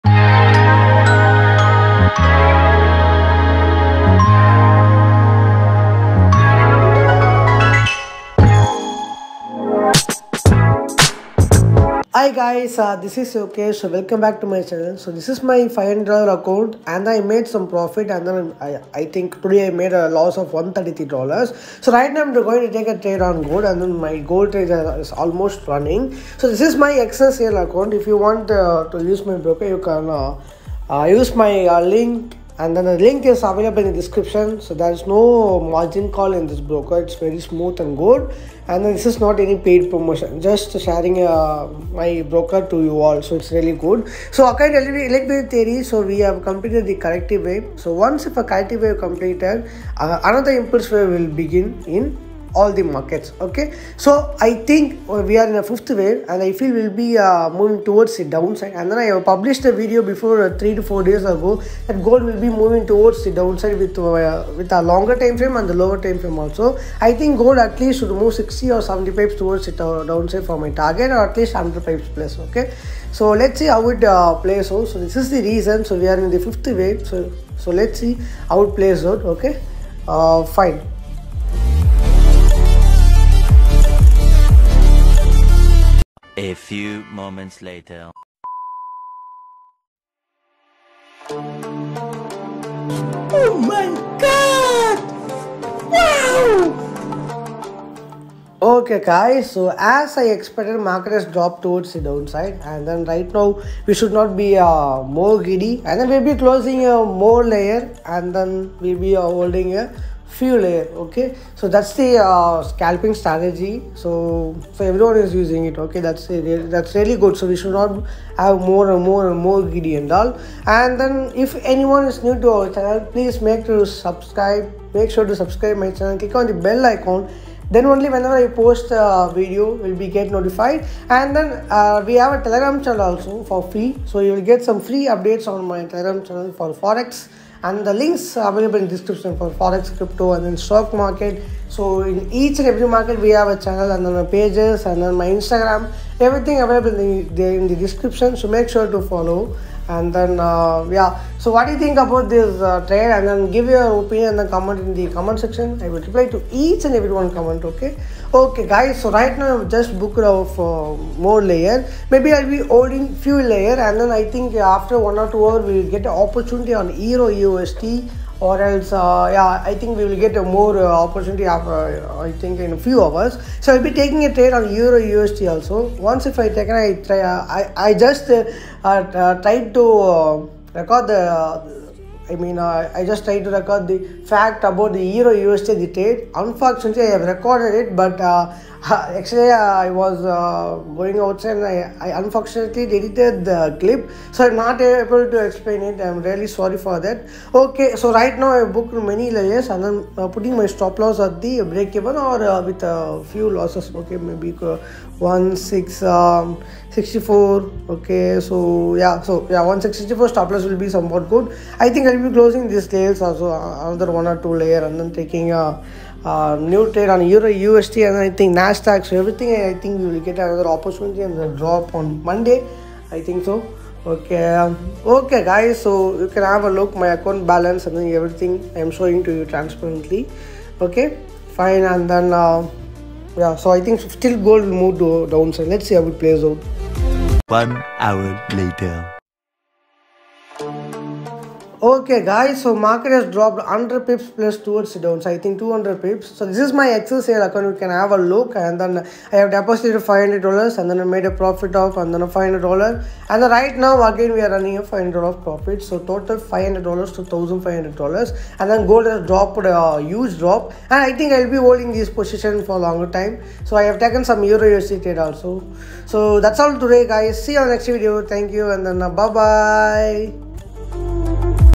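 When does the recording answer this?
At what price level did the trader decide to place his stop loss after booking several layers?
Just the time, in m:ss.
3:29.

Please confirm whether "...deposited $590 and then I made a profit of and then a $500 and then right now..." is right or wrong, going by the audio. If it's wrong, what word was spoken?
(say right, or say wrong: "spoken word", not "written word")
wrong: "500", not "590".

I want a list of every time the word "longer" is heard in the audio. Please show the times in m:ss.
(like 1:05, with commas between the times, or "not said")
1:04, 4:22.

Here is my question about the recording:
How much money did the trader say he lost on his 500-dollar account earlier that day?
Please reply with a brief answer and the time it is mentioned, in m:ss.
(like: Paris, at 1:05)
$133, at 0:20.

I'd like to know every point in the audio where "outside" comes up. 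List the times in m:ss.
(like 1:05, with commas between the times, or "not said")
3:11.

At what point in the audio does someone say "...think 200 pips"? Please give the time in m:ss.
4:05.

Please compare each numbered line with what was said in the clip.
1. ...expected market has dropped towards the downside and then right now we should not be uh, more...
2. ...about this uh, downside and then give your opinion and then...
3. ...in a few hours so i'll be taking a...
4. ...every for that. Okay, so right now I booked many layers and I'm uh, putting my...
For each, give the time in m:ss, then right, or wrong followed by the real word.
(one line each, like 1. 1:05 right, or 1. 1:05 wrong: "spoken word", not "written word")
1. 1:40 right
2. 2:32 wrong: "trade", not "downside"
3. 2:52 right
4. 3:16 wrong: "sorry", not "every".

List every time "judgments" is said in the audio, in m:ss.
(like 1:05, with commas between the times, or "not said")
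not said.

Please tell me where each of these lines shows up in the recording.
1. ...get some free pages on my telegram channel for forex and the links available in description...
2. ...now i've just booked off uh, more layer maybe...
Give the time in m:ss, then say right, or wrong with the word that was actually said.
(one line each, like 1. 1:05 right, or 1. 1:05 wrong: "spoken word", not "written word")
1. 2:14 wrong: "updates", not "pages"
2. 2:39 right.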